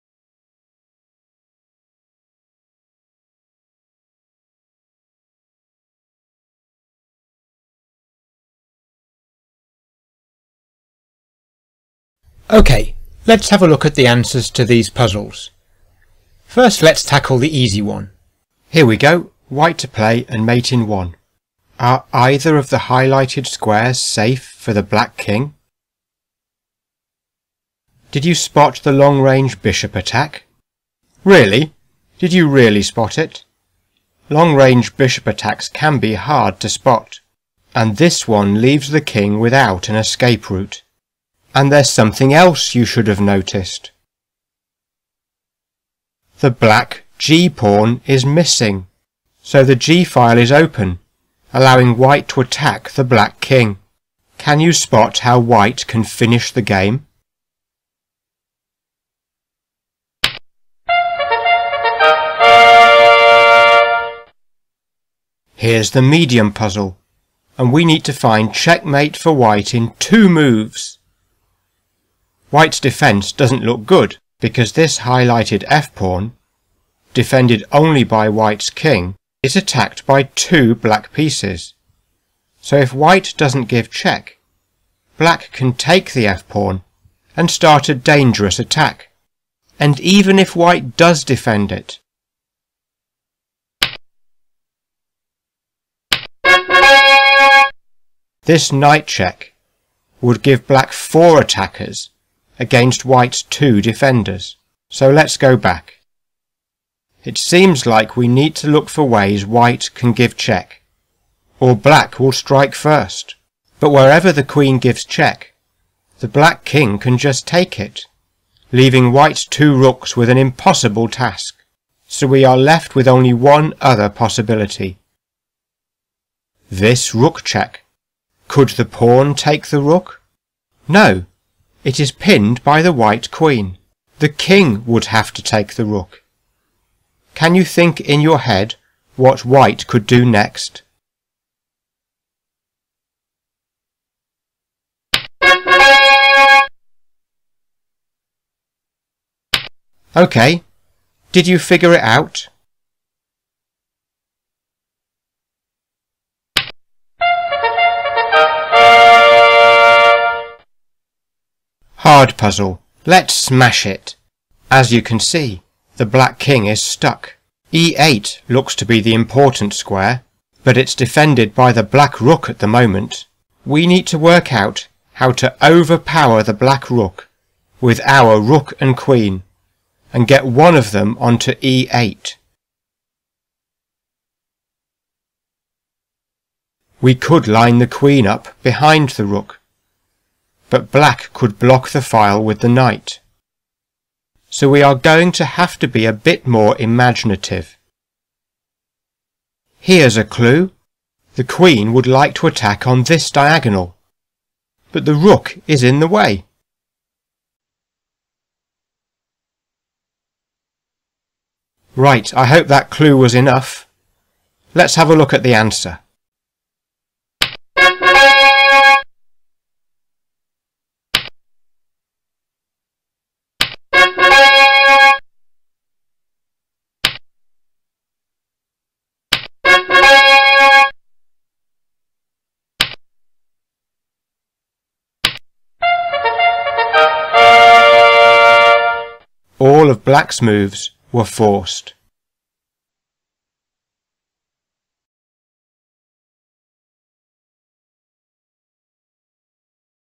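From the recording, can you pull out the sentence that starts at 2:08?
Could the pawn take the rook?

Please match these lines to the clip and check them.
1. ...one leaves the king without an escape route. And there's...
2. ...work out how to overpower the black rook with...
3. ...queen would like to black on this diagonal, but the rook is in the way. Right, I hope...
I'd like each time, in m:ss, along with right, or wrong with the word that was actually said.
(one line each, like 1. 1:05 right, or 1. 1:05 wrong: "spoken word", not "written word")
1. 0:38 right
2. 2:54 right
3. 3:21 wrong: "attack", not "black".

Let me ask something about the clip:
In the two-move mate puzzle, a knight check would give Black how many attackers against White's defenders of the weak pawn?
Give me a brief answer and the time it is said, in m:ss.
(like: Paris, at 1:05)
4, at 1:40.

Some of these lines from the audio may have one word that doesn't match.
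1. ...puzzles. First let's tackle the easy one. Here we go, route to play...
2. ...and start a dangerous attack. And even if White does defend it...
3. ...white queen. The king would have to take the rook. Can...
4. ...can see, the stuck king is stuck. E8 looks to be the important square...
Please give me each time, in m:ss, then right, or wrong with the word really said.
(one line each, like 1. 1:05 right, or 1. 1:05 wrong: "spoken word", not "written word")
1. 0:14 wrong: "white", not "route"
2. 1:27 right
3. 2:12 right
4. 2:45 wrong: "black", not "stuck".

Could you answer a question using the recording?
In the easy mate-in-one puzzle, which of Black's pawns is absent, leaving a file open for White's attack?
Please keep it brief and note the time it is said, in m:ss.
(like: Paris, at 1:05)
G pawn, at 0:46.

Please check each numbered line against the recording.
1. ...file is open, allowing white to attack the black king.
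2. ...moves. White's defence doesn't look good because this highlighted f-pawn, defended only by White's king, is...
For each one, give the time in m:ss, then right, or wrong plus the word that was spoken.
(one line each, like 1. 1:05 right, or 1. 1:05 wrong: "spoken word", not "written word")
1. 0:50 right
2. 1:10 right.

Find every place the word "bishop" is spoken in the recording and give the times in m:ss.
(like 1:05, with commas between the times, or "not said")
0:29, 0:34.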